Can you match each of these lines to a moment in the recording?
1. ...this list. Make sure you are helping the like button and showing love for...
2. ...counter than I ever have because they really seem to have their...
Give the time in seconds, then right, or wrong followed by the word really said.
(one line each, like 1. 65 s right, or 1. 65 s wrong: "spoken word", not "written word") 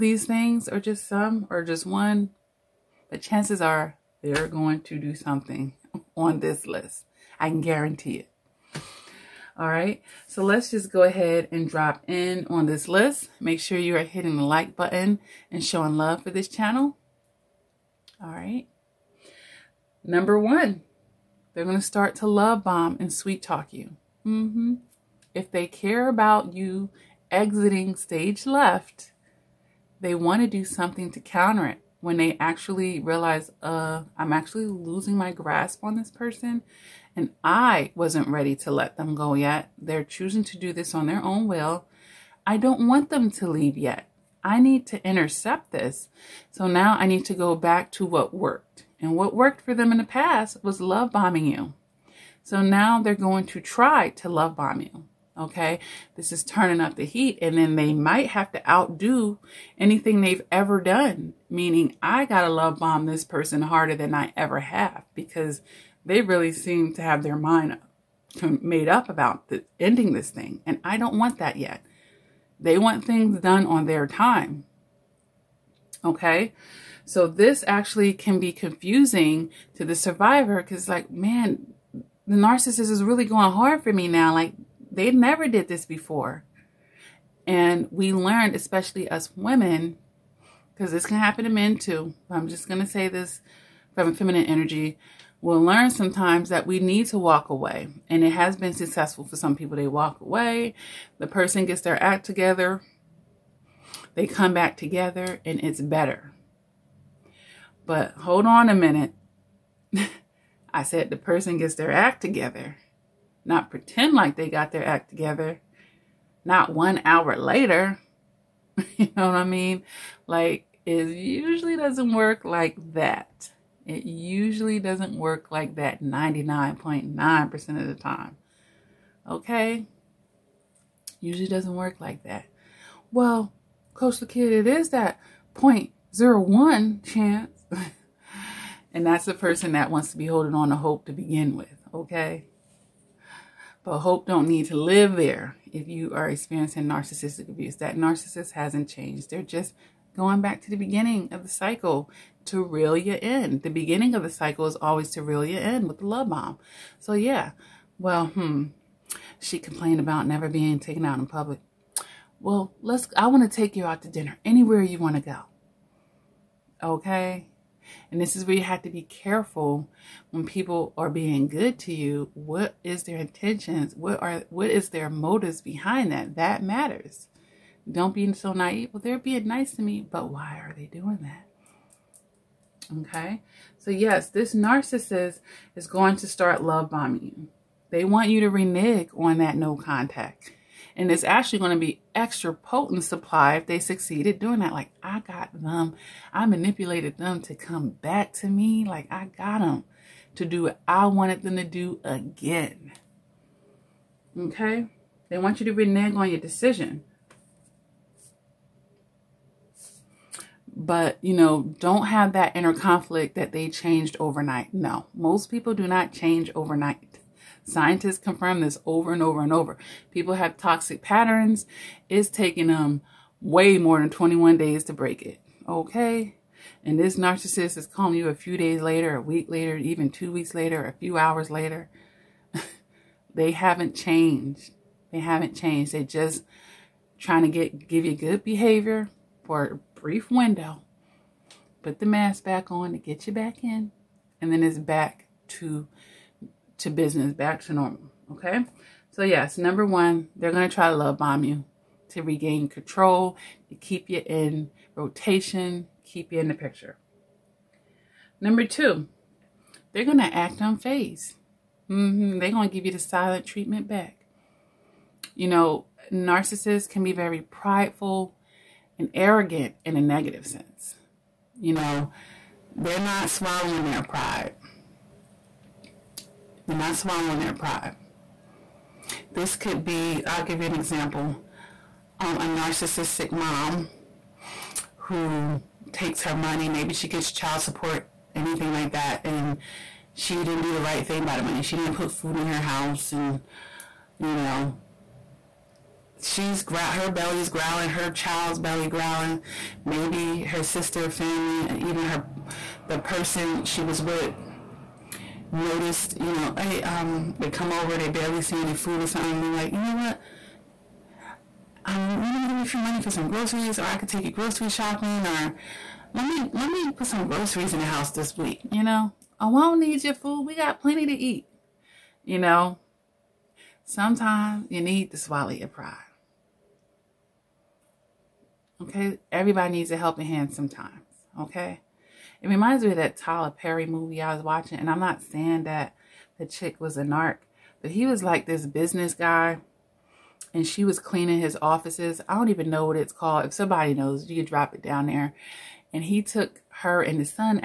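1. 12 s wrong: "hitting", not "helping"
2. 63 s wrong: "harder", not "counter".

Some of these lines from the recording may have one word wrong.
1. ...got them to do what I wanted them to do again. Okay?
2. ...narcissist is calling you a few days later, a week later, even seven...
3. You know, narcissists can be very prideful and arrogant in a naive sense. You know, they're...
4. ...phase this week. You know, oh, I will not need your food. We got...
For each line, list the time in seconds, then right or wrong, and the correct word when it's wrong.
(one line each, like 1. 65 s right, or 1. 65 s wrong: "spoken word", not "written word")
1. 199 s right
2. 227 s wrong: "two", not "seven"
3. 265 s wrong: "negative", not "naive"
4. 317 s wrong: "house", not "phase".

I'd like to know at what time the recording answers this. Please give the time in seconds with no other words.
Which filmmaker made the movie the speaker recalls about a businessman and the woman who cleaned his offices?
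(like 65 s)
333 s.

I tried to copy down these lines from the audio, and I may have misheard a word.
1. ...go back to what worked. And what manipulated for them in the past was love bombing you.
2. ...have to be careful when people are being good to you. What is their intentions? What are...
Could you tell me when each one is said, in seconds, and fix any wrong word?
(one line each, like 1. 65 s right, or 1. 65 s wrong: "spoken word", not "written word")
1. 47 s wrong: "worked", not "manipulated"
2. 168 s right.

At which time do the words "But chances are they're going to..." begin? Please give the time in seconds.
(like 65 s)
3 s.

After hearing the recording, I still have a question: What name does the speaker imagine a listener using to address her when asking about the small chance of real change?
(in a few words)
Coach Lakia.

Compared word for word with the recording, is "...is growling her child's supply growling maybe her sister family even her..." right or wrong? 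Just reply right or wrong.
wrong.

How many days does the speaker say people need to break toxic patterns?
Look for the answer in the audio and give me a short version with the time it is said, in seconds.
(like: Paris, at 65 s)
21, at 224 s.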